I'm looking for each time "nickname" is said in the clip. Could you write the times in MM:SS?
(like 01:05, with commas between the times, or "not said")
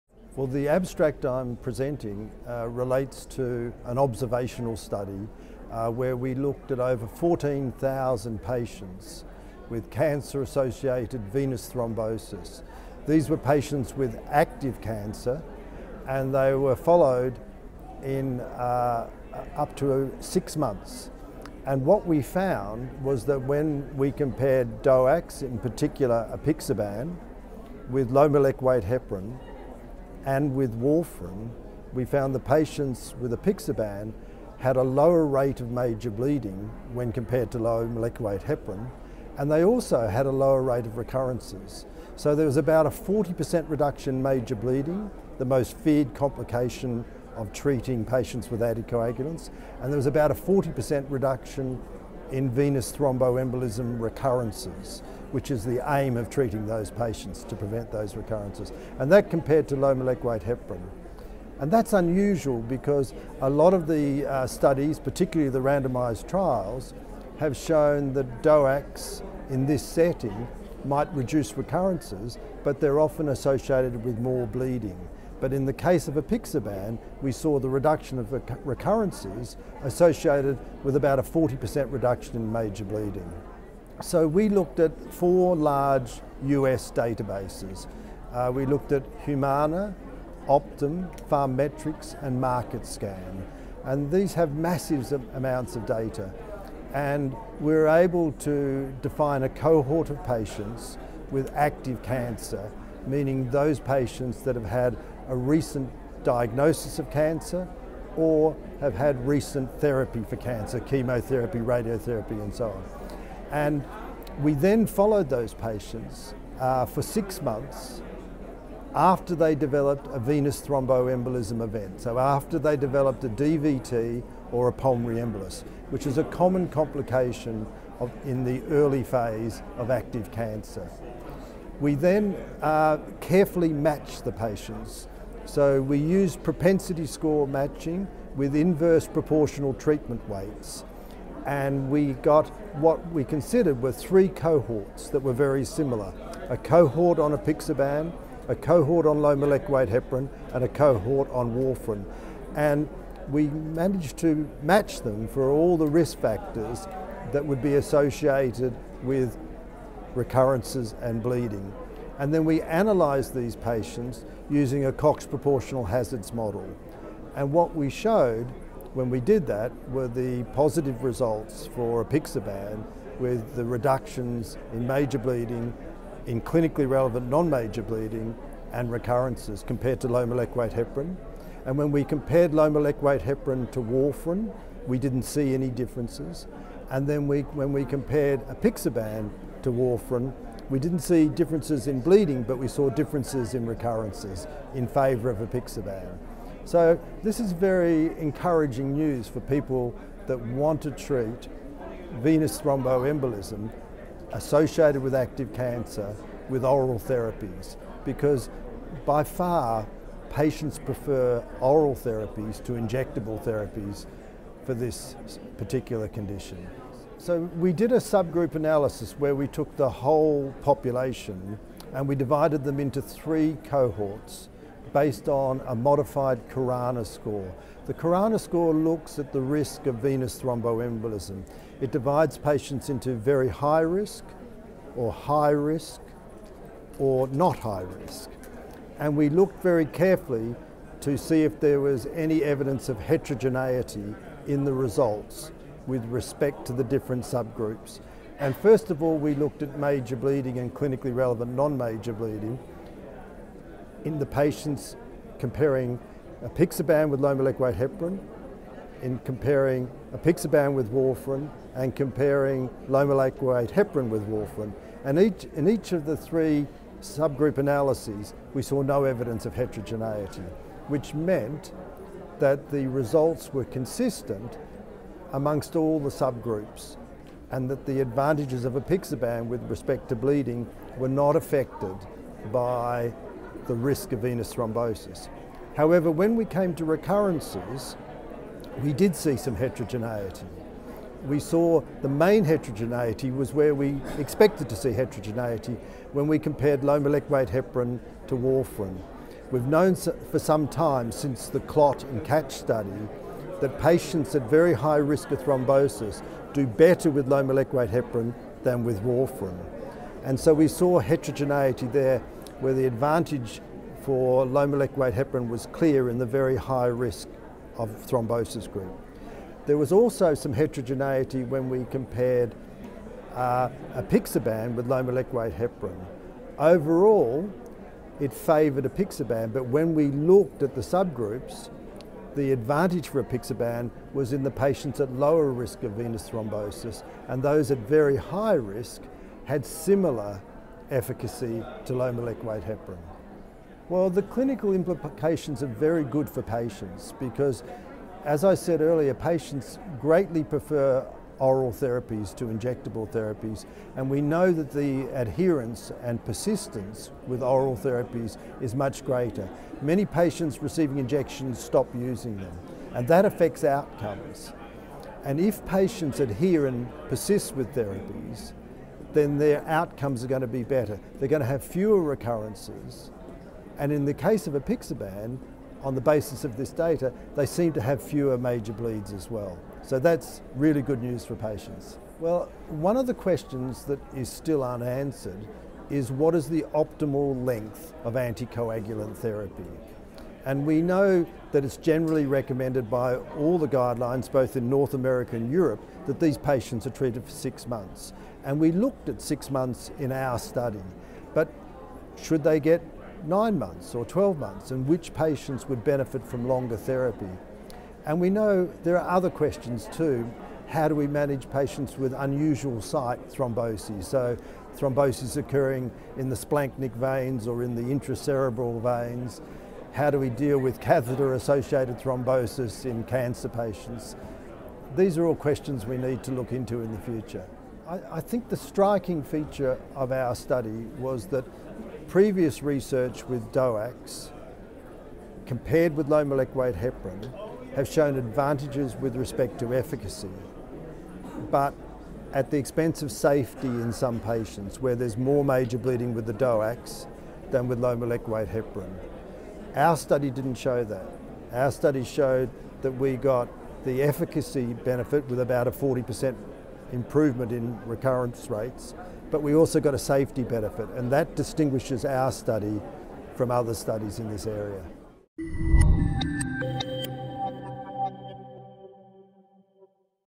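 not said.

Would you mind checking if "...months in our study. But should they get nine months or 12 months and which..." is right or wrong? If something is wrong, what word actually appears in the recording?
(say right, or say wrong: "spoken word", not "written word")
right.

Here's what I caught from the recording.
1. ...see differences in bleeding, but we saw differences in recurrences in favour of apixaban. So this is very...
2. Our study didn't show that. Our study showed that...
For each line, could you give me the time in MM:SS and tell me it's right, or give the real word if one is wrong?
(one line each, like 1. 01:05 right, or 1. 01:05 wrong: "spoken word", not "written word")
1. 03:10 right
2. 07:29 right.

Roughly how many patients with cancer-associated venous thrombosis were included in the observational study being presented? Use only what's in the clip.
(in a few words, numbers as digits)
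14,000.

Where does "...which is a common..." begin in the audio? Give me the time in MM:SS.
02:05.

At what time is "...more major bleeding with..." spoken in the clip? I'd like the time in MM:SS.
07:25.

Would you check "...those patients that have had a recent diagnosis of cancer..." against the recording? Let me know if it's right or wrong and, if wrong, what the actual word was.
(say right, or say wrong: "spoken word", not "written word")
right.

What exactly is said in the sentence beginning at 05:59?
Many patients receiving injections stop using them, and that affects outcomes.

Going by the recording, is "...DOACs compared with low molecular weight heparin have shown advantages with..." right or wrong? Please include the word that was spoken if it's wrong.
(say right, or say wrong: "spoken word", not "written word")
right.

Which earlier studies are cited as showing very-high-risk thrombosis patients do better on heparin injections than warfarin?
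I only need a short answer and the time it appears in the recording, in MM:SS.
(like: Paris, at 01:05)
CLOT and CATCH, at 05:01.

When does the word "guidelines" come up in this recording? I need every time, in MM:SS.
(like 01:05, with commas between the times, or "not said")
06:33.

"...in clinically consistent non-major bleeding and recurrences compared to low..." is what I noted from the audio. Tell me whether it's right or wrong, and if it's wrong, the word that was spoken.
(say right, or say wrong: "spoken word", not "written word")
wrong: "relevant", not "consistent".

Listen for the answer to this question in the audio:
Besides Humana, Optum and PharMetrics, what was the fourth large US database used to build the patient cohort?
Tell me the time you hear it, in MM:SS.
01:32.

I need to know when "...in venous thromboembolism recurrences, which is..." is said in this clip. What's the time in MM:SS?
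00:52.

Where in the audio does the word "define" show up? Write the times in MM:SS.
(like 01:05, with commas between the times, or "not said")
01:39.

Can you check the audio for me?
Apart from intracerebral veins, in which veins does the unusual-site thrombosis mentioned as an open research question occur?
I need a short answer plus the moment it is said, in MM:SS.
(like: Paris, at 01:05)
splanchnic veins, at 06:56.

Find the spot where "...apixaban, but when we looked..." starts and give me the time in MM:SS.
05:28.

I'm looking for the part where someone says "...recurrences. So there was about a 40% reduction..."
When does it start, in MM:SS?
00:40.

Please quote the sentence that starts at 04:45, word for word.
However, when we came to recurrences, we did see some heterogeneity.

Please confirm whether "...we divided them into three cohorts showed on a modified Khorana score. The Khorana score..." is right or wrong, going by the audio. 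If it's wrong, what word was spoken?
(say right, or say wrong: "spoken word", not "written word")
wrong: "based", not "showed".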